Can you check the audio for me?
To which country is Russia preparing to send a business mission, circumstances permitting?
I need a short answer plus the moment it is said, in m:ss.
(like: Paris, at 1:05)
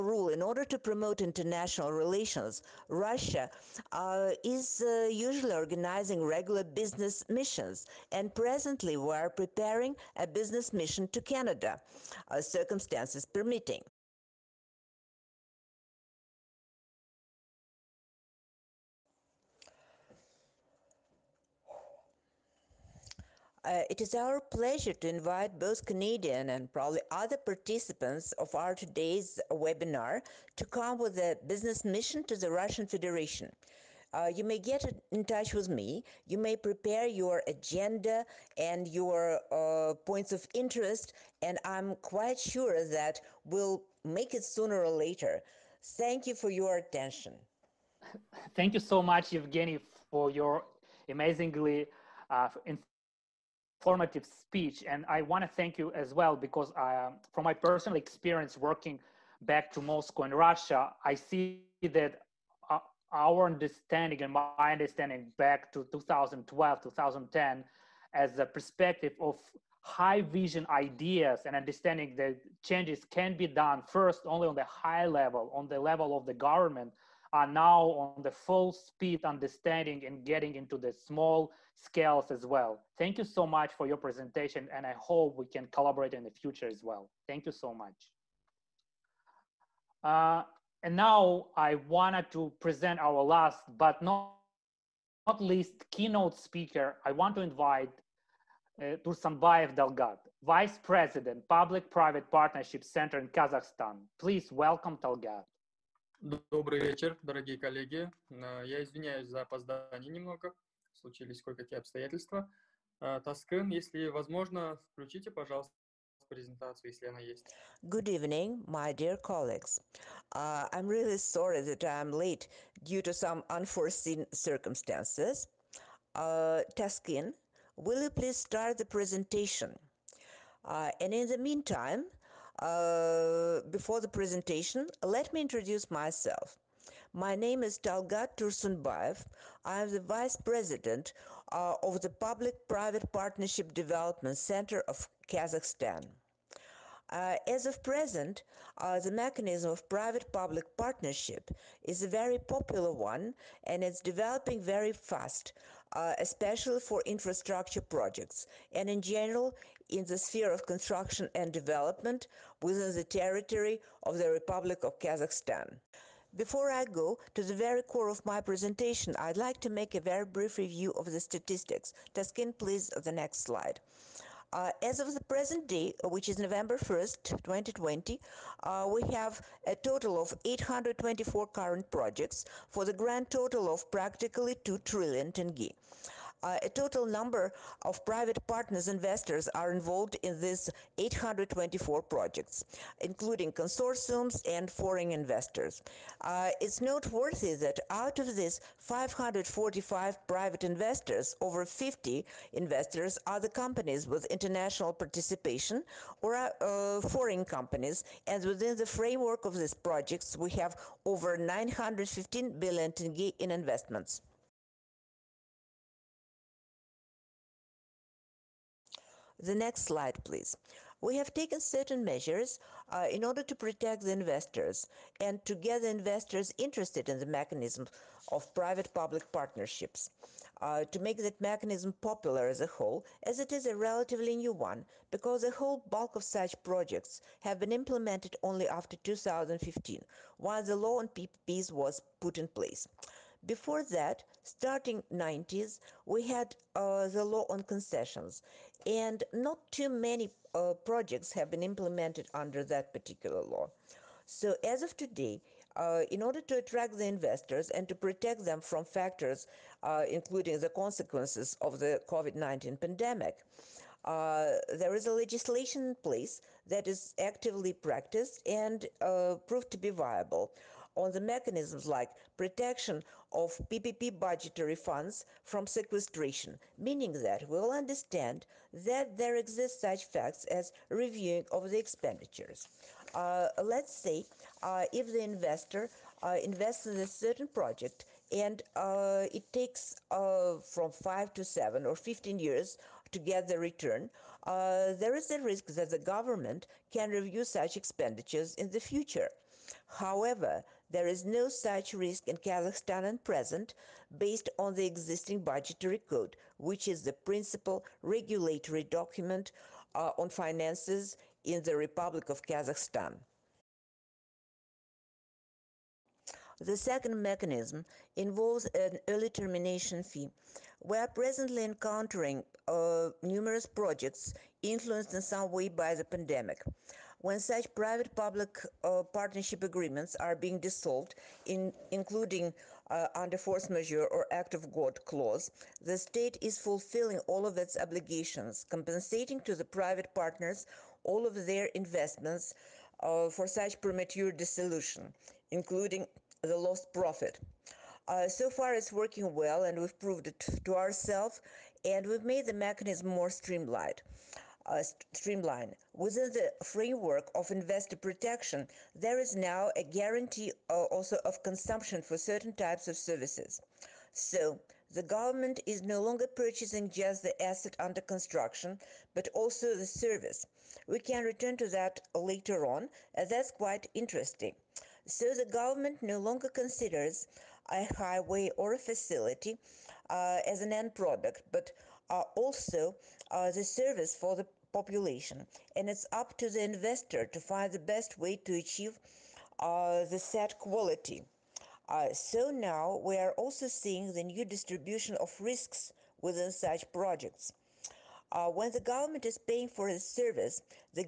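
Canada, at 0:11.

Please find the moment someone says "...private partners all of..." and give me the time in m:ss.
5:39.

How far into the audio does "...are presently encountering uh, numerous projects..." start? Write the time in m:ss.
5:20.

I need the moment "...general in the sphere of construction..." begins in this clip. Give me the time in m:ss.
2:39.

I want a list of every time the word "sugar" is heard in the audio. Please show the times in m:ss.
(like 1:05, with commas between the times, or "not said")
not said.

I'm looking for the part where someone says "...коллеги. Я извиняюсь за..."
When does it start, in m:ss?
1:47.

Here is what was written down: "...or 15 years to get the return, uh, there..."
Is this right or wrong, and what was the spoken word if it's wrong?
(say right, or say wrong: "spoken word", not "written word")
right.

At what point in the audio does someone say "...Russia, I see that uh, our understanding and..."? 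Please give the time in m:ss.
1:00.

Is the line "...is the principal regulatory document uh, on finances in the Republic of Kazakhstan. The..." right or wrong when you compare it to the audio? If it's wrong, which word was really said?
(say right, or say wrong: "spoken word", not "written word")
right.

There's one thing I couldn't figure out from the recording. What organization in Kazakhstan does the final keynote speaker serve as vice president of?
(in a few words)
Public-Private Partnership Center.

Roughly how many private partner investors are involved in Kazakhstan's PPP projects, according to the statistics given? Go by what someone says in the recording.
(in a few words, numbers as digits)
545.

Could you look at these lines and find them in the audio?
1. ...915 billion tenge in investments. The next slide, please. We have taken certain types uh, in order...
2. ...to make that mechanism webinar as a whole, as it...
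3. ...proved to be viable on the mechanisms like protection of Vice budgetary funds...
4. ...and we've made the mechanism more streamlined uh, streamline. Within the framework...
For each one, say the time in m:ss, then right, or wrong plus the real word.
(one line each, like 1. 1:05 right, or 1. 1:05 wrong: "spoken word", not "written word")
1. 3:31 wrong: "measures", not "types"
2. 3:50 wrong: "popular", not "webinar"
3. 4:29 wrong: "PPP", not "Vice"
4. 5:51 right.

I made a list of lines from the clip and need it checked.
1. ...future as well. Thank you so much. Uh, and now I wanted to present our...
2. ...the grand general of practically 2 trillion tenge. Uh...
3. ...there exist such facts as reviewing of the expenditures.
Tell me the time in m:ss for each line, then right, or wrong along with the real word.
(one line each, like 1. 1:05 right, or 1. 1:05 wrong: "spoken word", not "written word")
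1. 1:26 right
2. 3:02 wrong: "total", not "general"
3. 4:39 right.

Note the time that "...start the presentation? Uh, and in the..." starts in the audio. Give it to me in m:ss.
2:08.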